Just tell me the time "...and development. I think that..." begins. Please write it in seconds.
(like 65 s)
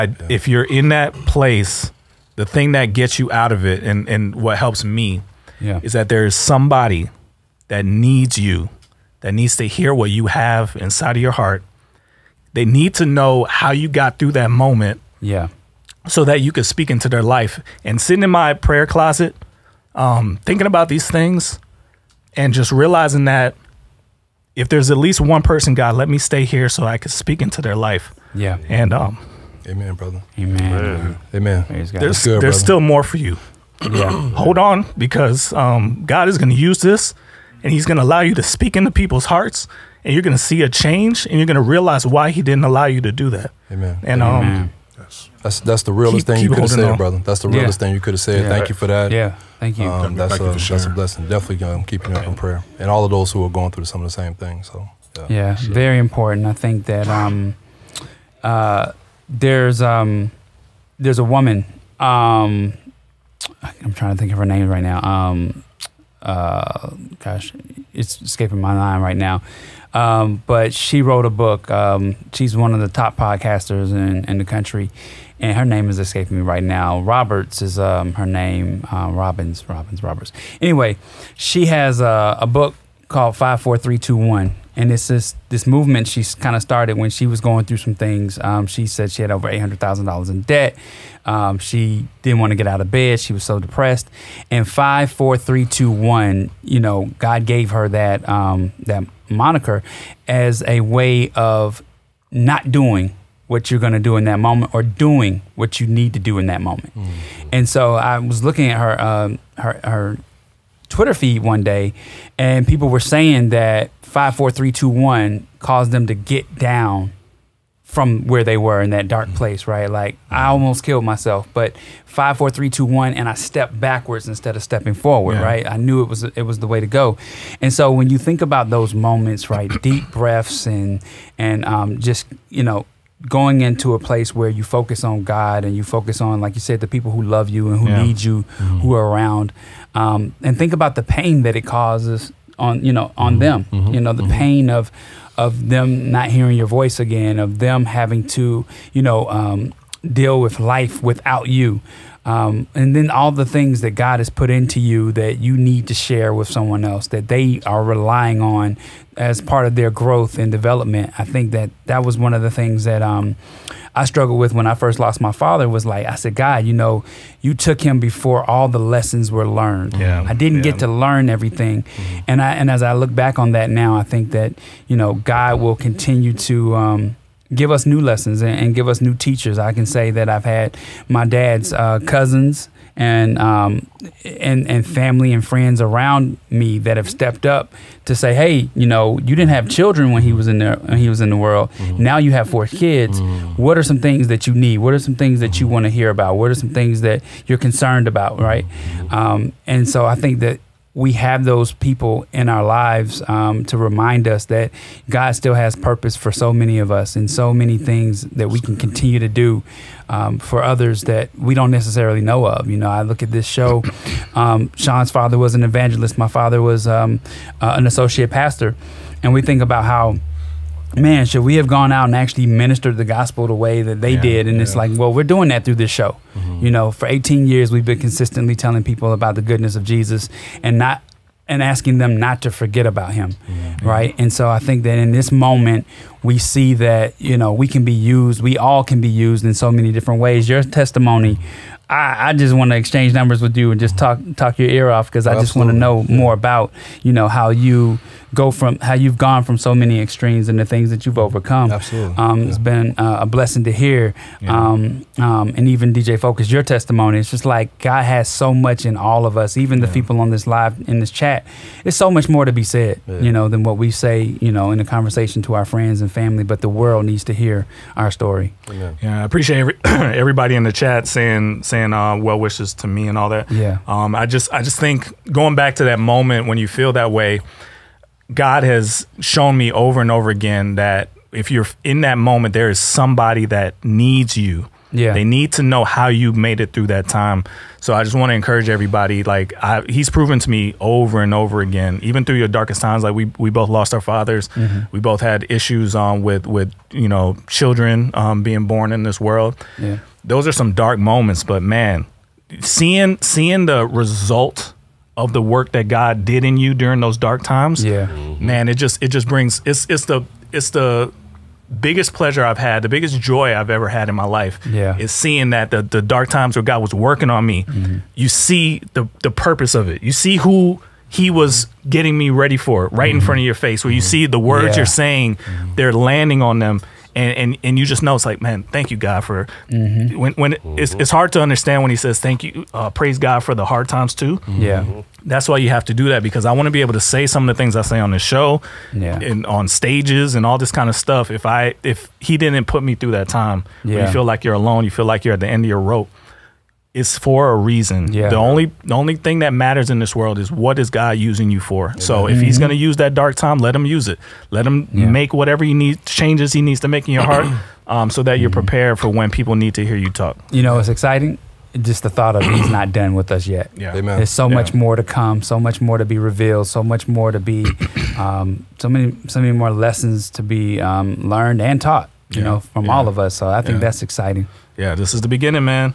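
160 s.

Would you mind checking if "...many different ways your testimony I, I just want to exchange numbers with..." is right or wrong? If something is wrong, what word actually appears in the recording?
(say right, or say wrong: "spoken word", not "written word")
right.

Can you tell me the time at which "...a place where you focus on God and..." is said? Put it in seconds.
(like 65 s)
133 s.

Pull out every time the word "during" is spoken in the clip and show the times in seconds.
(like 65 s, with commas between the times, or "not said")
306 s.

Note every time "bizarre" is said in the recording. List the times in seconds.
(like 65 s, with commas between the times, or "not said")
not said.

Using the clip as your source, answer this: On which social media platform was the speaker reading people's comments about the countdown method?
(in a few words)
Twitter.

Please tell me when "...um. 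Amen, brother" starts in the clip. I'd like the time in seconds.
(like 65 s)
28 s.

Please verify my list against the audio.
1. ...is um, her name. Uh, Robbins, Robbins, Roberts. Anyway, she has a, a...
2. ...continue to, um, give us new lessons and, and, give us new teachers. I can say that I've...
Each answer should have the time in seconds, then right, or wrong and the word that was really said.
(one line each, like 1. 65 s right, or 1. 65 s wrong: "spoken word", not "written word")
1. 77 s right
2. 175 s right.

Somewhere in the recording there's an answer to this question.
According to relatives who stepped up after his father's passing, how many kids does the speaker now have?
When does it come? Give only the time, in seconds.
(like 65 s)
192 s.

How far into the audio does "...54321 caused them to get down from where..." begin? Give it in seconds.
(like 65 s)
114 s.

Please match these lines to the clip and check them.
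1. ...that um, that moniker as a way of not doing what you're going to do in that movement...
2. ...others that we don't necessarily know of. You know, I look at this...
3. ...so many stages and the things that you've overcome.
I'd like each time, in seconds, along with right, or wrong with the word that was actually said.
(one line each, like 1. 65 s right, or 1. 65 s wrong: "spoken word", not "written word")
1. 97 s wrong: "moment", not "movement"
2. 210 s right
3. 249 s wrong: "extremes", not "stages".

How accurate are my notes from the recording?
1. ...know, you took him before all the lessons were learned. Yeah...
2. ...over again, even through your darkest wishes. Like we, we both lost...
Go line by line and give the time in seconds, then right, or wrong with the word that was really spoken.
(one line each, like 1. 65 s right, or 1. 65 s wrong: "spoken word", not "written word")
1. 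166 s right
2. 291 s wrong: "times", not "wishes".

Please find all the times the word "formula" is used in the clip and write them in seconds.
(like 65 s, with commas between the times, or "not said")
not said.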